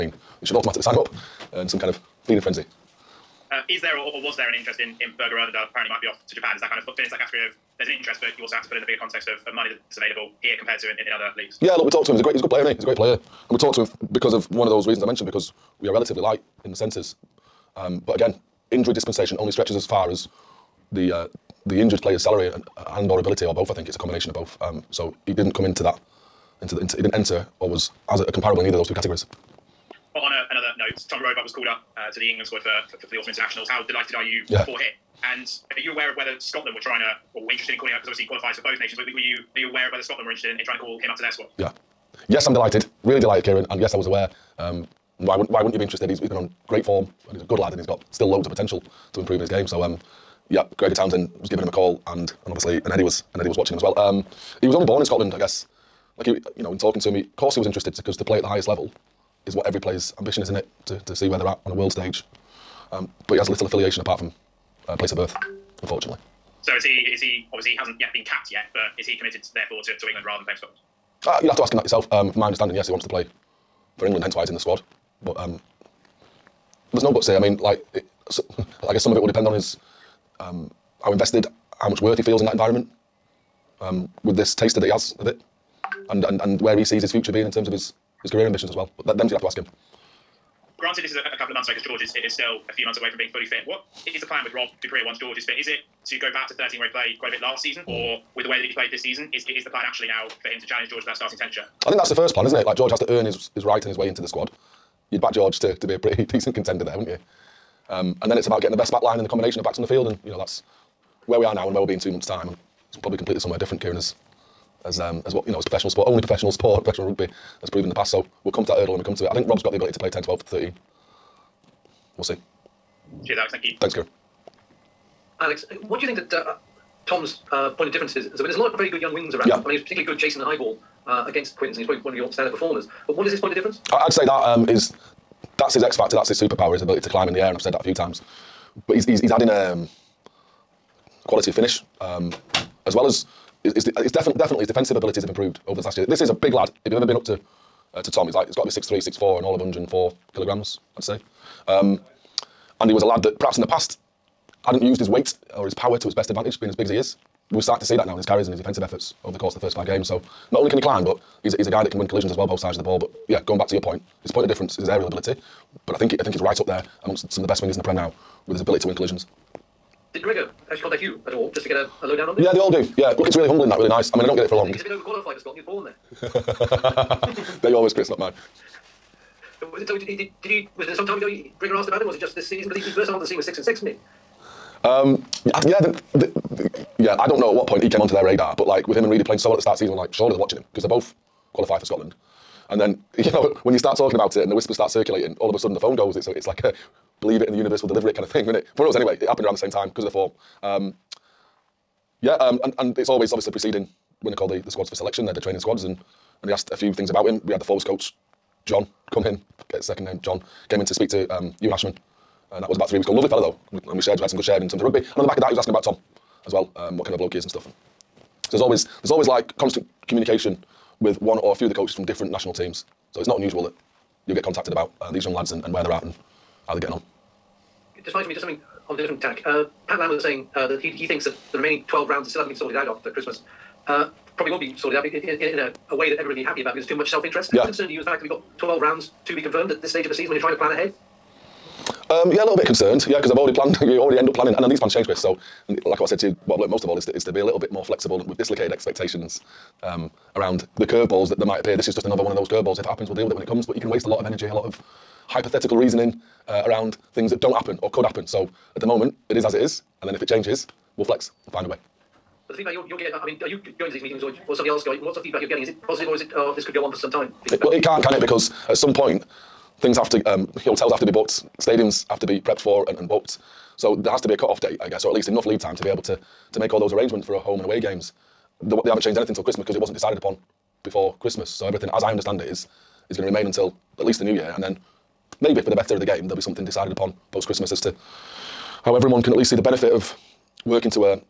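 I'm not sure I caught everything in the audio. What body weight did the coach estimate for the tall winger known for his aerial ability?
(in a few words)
104 kilograms.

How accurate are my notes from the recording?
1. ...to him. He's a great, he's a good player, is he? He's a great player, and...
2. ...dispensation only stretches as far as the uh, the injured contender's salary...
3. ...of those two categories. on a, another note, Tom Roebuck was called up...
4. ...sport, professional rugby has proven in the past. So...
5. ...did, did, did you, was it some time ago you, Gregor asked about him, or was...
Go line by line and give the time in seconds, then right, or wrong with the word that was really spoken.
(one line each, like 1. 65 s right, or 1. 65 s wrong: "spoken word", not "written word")
1. 12 s right
2. 18 s wrong: "player", not "contender"
3. 28 s right
4. 116 s right
5. 179 s right.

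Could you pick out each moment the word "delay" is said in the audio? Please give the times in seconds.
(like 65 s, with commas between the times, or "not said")
not said.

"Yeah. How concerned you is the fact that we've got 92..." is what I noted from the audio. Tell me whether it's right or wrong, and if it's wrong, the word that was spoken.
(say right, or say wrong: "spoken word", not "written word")
wrong: "12", not "92".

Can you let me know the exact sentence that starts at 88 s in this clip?
But that, them's you'll have to ask him.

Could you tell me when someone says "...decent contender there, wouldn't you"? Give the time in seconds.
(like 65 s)
106 s.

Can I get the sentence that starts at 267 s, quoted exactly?
It, well, it can't, can it?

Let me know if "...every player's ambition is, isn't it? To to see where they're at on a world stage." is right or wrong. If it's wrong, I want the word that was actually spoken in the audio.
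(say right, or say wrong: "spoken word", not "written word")
right.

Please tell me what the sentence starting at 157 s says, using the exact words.
We are starting to see that now in his carries and his defensive efforts over the course of the first five games.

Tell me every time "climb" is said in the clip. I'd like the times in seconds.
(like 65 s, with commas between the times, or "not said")
137 s, 160 s.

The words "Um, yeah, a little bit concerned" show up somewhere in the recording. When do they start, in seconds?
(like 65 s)
242 s.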